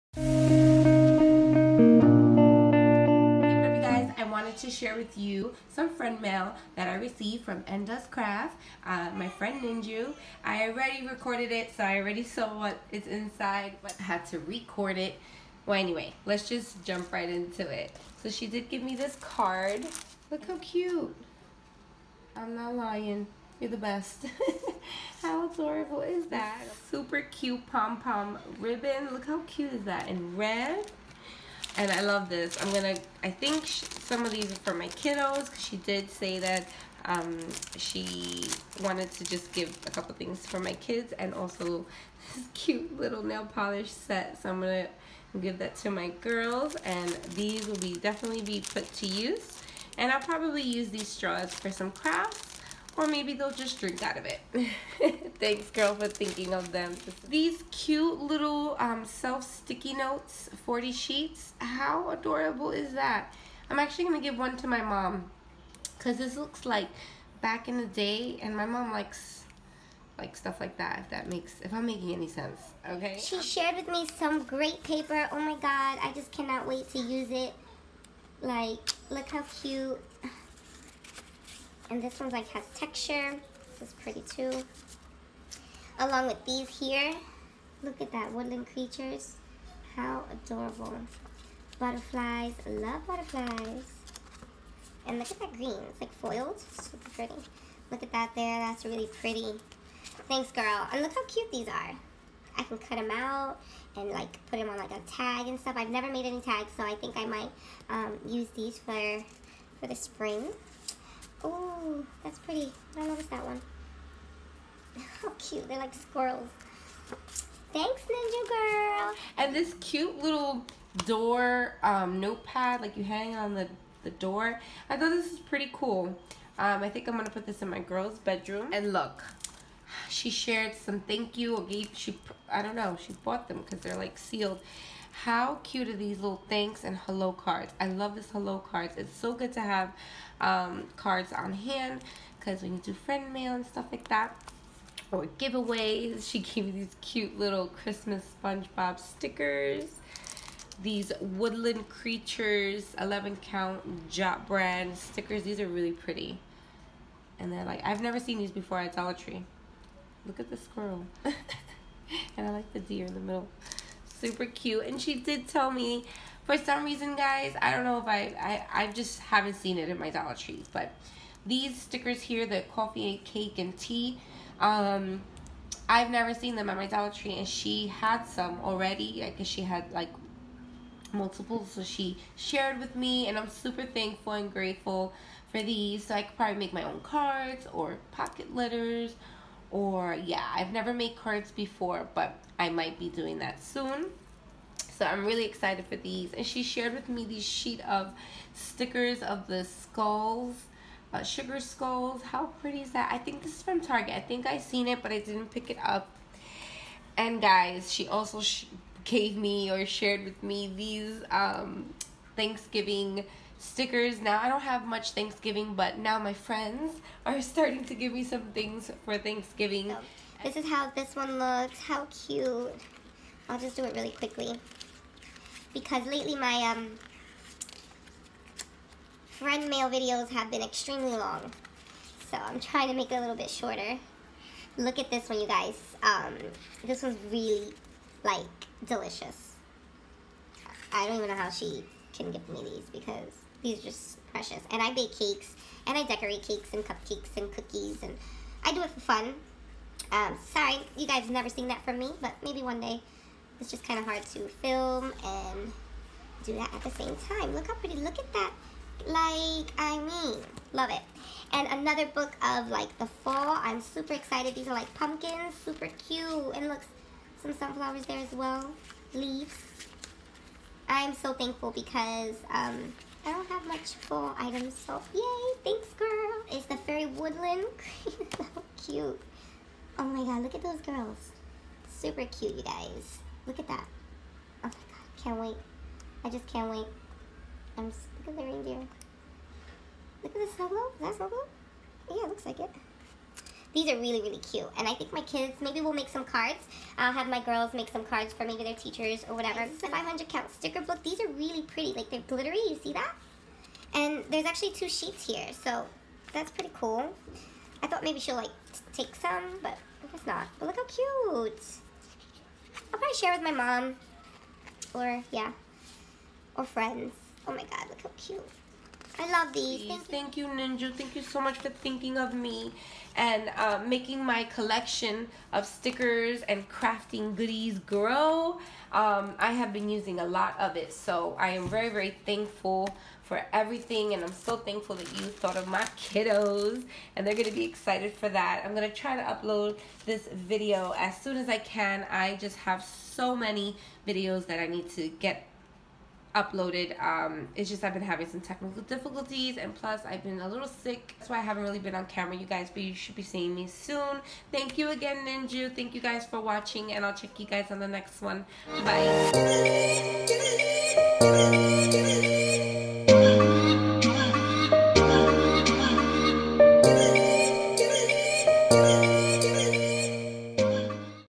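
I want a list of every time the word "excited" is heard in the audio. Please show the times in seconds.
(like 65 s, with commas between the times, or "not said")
195 s, 264 s, 337 s.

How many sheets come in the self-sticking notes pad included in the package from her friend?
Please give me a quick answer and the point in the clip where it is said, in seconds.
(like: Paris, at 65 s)
40, at 60 s.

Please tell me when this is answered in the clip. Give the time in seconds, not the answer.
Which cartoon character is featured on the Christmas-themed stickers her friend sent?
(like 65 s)
148 s.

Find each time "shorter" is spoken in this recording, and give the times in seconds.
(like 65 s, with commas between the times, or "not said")
233 s.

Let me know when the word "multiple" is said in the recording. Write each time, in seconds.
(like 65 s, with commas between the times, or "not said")
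181 s.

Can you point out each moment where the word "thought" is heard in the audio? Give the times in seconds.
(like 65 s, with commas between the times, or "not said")
124 s, 307 s, 335 s.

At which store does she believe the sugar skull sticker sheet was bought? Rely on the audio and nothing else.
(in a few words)
Target.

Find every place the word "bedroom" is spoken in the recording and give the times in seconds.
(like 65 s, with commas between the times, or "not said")
128 s.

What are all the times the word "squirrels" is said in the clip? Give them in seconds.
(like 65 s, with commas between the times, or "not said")
115 s, 160 s.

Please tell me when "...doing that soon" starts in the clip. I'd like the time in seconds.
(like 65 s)
193 s.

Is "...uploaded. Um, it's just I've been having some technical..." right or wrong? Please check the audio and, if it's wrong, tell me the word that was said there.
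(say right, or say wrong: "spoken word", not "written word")
right.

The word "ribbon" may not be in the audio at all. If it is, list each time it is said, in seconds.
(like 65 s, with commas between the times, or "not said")
28 s.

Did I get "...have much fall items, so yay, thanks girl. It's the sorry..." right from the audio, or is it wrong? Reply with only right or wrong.
wrong.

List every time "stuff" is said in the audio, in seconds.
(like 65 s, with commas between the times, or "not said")
70 s, 105 s, 143 s.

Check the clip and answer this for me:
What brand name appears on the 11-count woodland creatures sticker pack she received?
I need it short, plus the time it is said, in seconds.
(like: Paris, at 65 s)
Jot, at 154 s.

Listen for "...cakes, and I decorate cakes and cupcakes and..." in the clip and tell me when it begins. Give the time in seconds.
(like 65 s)
245 s.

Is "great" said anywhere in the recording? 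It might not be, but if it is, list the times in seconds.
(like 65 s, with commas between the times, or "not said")
74 s.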